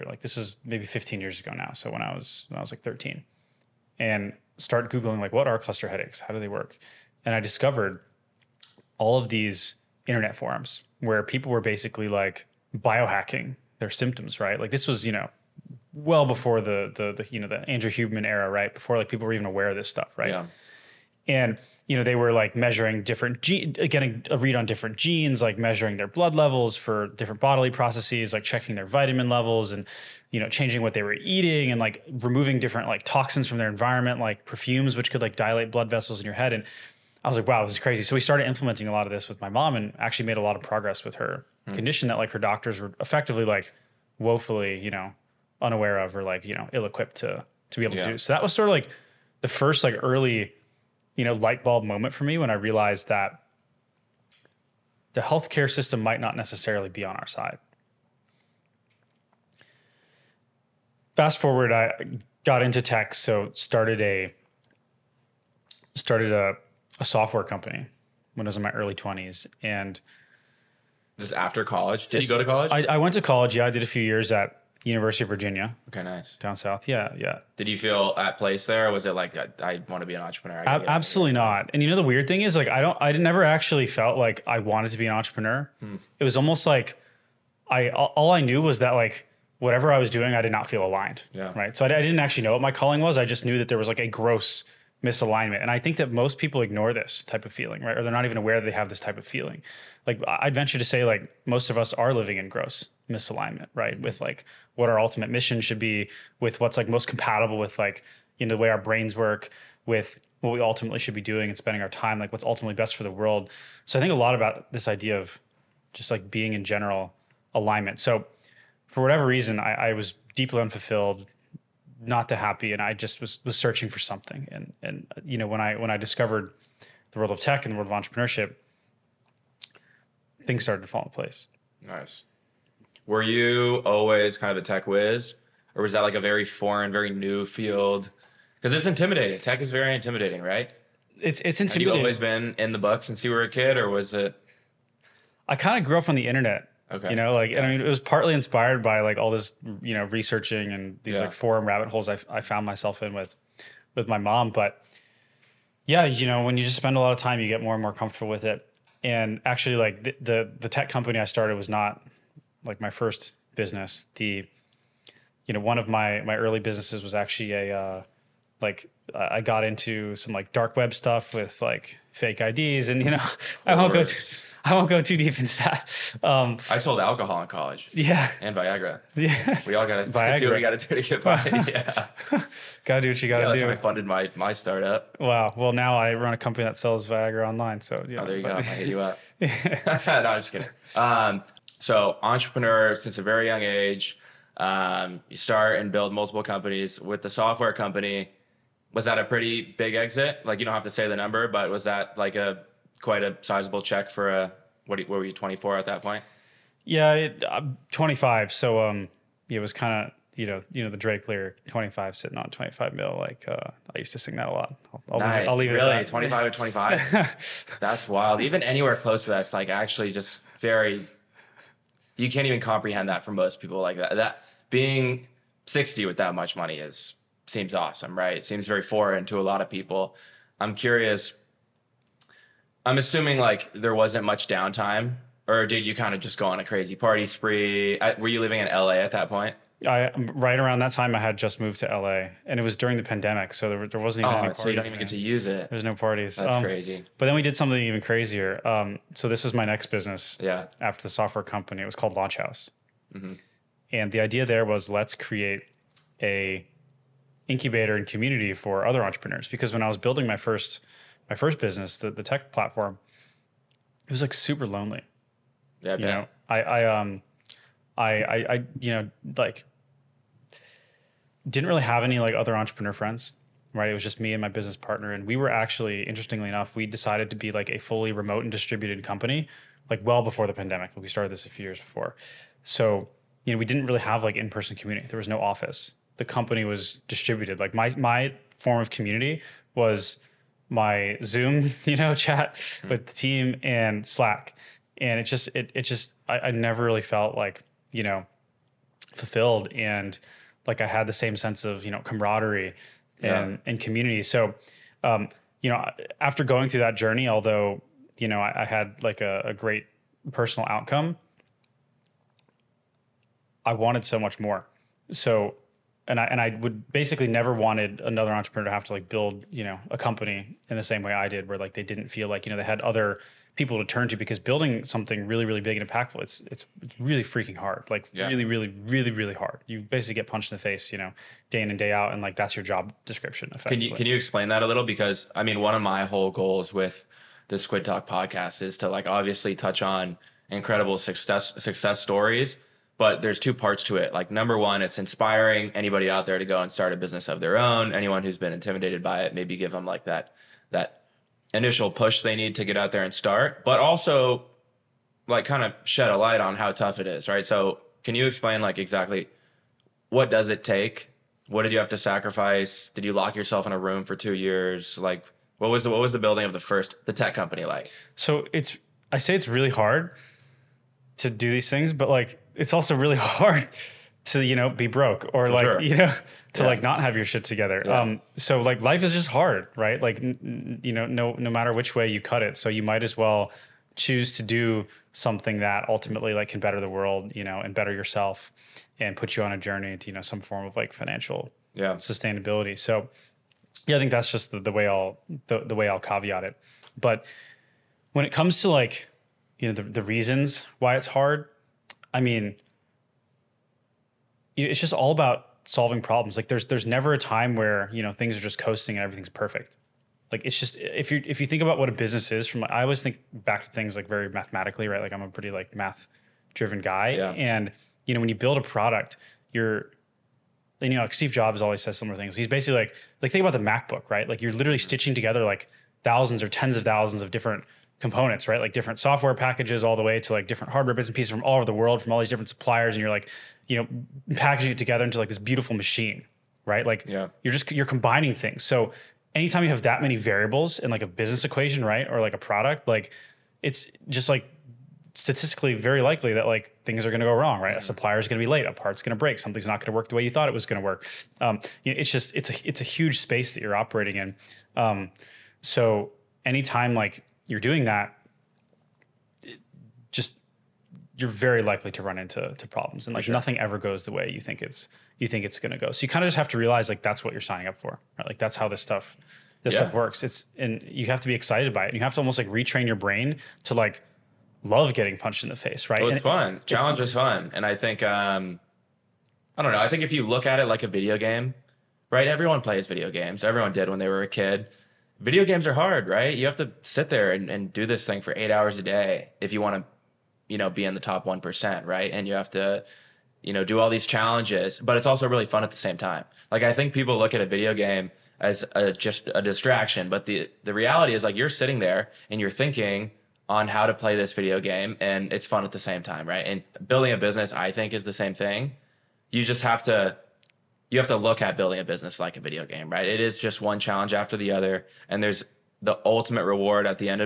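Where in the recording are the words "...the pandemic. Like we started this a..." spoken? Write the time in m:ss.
4:40.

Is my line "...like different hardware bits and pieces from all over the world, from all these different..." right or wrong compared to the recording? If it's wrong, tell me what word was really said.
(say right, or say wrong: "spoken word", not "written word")
right.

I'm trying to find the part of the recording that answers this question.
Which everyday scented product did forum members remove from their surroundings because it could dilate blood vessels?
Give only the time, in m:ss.
0:34.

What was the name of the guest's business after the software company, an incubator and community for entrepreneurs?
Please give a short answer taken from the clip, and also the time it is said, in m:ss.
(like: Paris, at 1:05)
Launch House, at 4:12.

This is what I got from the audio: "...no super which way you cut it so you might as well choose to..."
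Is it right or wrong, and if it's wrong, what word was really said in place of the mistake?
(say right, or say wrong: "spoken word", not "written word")
wrong: "matter", not "super".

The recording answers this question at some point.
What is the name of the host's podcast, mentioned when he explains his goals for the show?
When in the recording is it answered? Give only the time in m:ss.
5:37.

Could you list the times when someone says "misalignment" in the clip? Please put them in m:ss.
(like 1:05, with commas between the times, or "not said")
1:35, 1:43.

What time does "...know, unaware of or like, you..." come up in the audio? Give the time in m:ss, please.
0:44.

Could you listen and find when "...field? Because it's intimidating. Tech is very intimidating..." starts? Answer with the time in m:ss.
2:17.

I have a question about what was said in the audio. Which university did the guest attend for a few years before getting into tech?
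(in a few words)
University of Virginia.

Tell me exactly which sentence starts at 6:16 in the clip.
like not have your shit together yeah.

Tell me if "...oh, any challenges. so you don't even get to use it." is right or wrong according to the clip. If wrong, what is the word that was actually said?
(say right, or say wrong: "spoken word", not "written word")
wrong: "parties", not "challenges".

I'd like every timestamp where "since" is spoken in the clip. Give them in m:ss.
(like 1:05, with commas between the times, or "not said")
2:23, 3:12.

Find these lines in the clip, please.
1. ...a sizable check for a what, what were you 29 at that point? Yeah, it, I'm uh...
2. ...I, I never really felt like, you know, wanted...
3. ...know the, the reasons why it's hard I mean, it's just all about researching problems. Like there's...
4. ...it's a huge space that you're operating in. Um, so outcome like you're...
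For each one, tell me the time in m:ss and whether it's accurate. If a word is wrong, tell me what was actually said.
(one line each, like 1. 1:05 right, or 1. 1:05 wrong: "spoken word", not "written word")
1. 3:23 wrong: "24", not "29"
2. 4:56 wrong: "fulfilled", not "wanted"
3. 6:39 wrong: "solving", not "researching"
4. 7:32 wrong: "anytime", not "outcome".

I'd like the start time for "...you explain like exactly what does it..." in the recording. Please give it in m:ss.
5:58.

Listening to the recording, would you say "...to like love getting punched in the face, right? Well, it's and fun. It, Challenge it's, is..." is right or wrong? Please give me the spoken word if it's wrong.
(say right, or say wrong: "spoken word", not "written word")
right.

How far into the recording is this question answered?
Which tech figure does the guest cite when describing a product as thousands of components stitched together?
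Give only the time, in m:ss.
7:01.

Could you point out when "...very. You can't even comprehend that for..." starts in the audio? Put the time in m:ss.
3:40.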